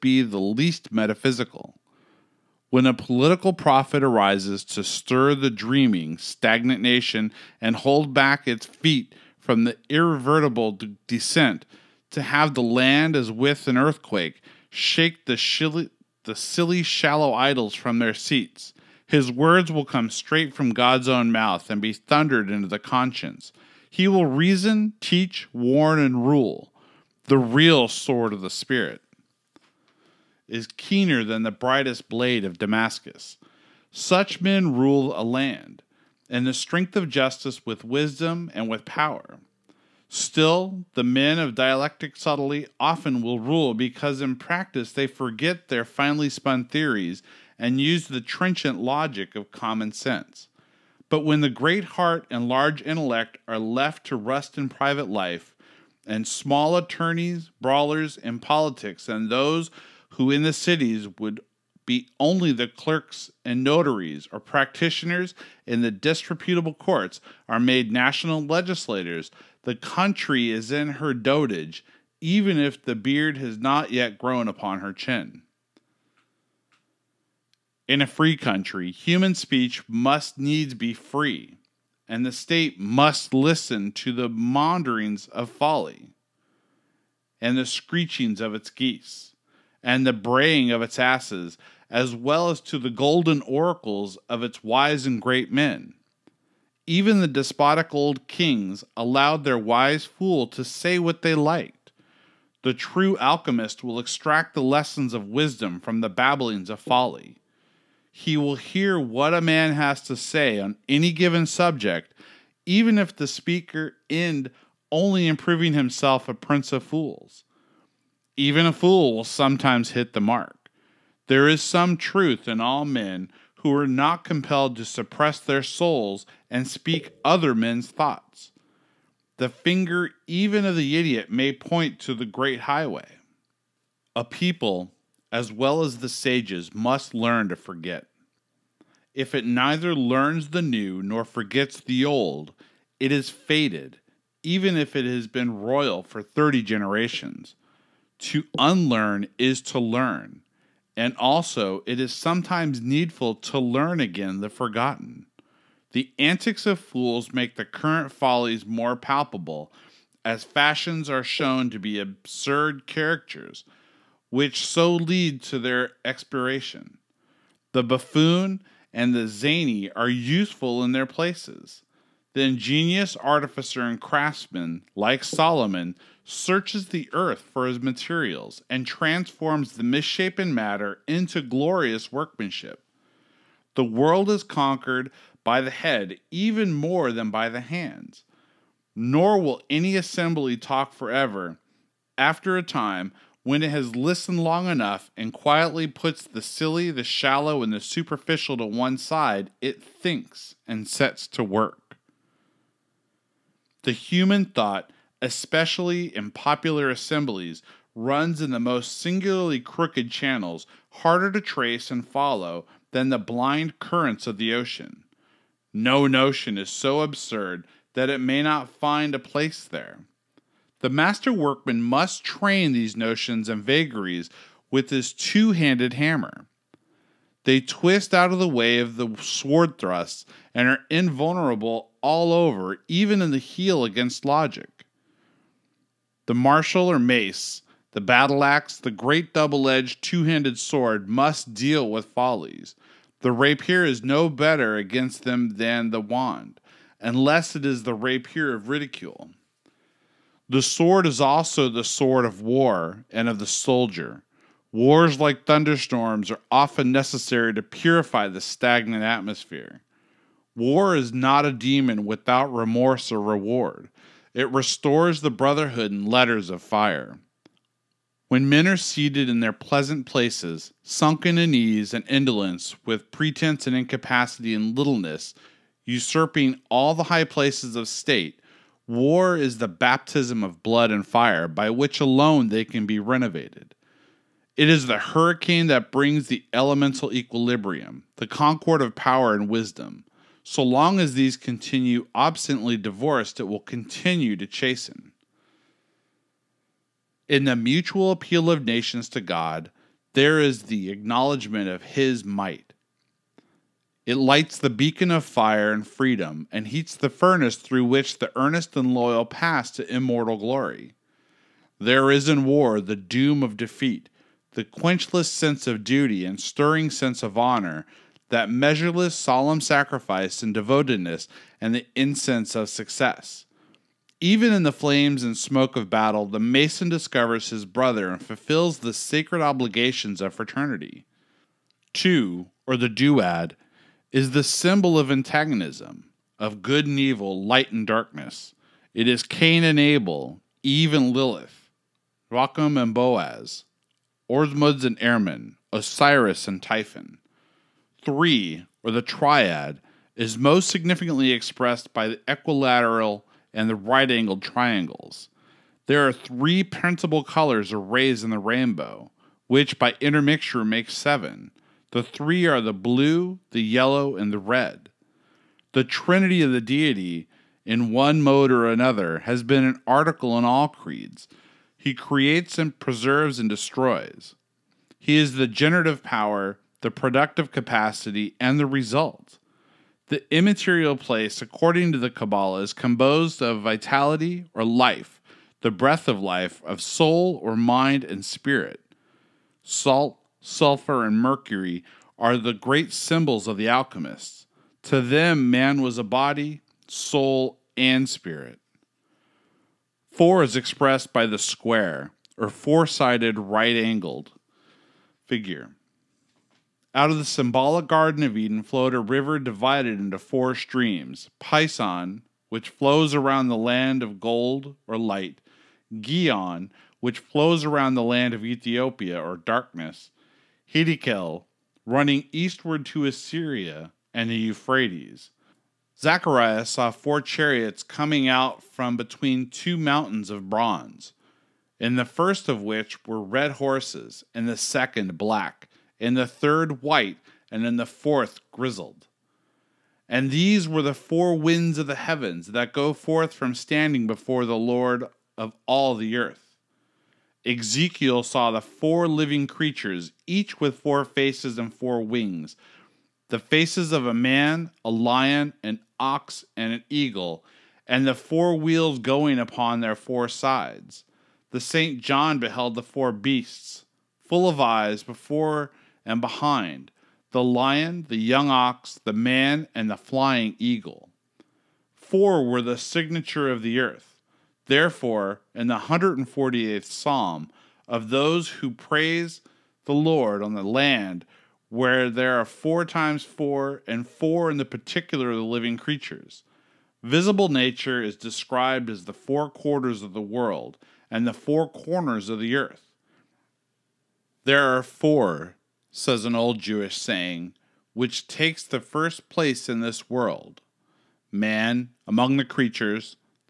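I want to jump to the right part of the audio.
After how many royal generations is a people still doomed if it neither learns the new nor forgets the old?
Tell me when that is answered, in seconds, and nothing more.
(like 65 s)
146 s.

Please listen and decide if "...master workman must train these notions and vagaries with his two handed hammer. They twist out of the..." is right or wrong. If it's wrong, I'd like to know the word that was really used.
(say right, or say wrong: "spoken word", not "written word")
right.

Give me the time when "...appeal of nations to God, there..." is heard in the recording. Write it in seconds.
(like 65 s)
298 s.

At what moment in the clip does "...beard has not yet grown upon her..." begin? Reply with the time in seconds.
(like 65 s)
72 s.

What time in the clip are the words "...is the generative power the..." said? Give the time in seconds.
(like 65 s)
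375 s.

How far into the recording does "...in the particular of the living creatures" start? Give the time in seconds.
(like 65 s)
484 s.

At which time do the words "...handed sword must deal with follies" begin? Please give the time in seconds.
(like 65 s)
240 s.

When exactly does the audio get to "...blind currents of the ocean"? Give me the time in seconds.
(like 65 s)
213 s.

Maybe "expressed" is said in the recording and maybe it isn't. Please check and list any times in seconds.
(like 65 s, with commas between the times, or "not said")
351 s, 400 s.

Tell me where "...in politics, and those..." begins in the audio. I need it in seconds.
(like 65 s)
58 s.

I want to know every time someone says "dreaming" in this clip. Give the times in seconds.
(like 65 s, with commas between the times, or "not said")
5 s.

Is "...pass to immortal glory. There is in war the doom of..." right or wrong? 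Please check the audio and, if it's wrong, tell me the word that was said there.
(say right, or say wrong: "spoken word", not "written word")
right.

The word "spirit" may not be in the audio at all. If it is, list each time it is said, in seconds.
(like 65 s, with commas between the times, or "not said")
28 s, 388 s, 398 s.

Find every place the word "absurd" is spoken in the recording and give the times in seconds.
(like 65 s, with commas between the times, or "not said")
161 s, 217 s.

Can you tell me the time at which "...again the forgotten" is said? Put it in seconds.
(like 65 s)
154 s.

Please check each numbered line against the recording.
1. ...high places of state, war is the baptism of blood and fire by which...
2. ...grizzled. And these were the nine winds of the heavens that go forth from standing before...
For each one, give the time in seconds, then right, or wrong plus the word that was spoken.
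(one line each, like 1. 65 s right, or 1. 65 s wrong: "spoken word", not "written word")
1. 277 s right
2. 438 s wrong: "four", not "nine".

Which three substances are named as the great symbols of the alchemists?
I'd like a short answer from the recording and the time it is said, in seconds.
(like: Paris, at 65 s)
Salt, sulfur, and mercury, at 389 s.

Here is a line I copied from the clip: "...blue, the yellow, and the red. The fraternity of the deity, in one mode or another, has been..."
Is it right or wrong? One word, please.
wrong.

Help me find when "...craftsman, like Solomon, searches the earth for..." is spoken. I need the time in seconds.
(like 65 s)
174 s.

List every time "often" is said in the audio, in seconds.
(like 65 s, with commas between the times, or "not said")
42 s, 256 s.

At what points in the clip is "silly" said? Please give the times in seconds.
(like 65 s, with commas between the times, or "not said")
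16 s, 196 s.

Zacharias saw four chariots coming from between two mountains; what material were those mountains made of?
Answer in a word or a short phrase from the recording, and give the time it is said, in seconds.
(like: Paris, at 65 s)
bronze, at 430 s.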